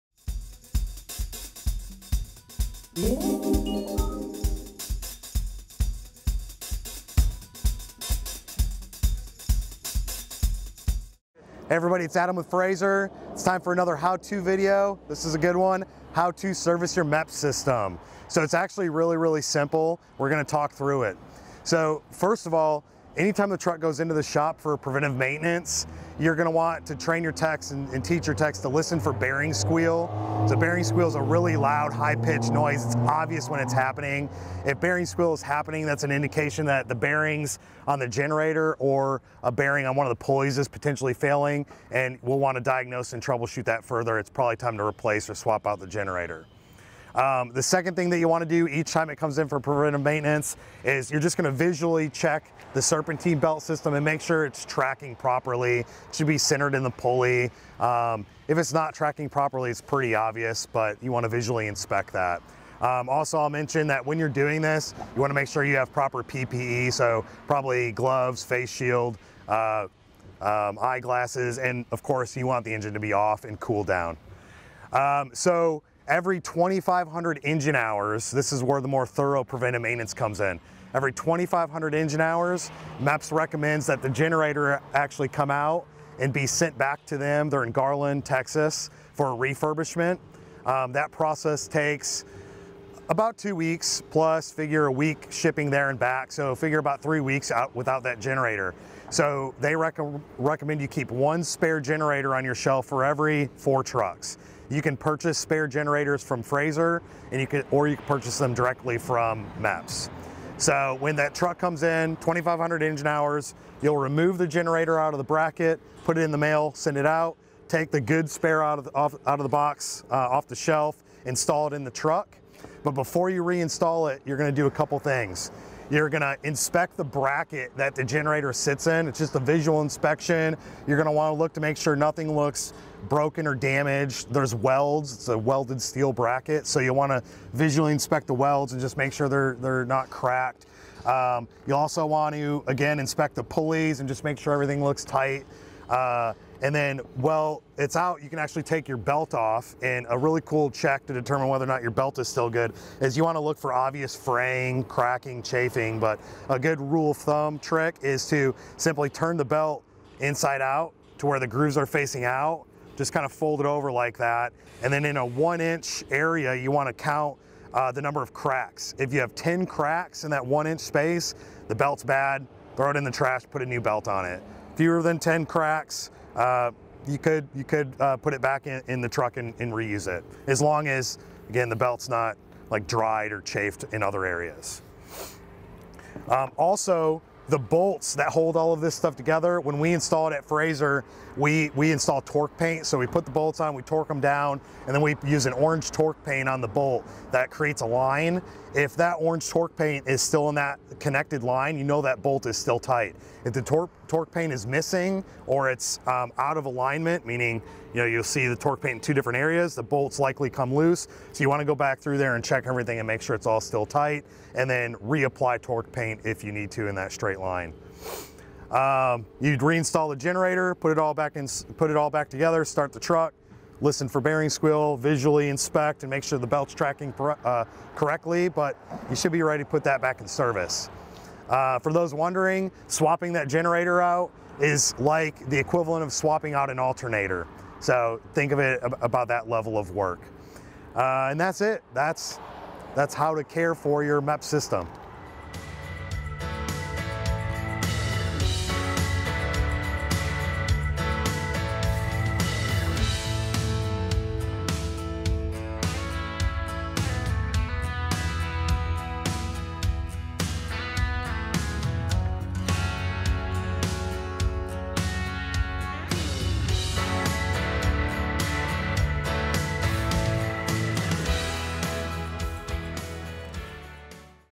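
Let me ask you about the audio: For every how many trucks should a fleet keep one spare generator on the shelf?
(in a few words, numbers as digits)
4.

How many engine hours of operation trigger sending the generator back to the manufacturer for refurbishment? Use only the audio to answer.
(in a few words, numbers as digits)
2,500.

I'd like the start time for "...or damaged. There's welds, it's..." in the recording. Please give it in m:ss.
2:13.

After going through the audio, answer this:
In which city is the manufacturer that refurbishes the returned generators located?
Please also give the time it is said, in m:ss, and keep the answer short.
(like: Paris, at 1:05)
Garland, Texas, at 1:27.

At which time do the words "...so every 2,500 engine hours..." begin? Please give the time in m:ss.
1:15.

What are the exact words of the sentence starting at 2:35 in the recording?
But a good rule of thumb trick is to simply turn the belt inside out to where the grooves are facing out.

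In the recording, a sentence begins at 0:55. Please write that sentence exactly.
It should be centered in the pulley.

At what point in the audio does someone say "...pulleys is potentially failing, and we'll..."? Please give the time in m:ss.
0:40.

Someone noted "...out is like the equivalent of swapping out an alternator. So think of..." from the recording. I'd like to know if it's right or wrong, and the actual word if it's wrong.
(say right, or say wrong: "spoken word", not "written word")
right.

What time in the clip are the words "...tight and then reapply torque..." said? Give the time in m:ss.
3:33.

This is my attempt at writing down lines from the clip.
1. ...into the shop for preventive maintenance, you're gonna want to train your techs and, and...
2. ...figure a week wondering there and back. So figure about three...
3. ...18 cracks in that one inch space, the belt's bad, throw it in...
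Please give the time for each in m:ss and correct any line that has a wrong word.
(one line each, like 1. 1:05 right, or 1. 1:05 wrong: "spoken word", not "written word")
1. 0:23 right
2. 1:34 wrong: "shipping", not "wondering"
3. 2:49 wrong: "10", not "18".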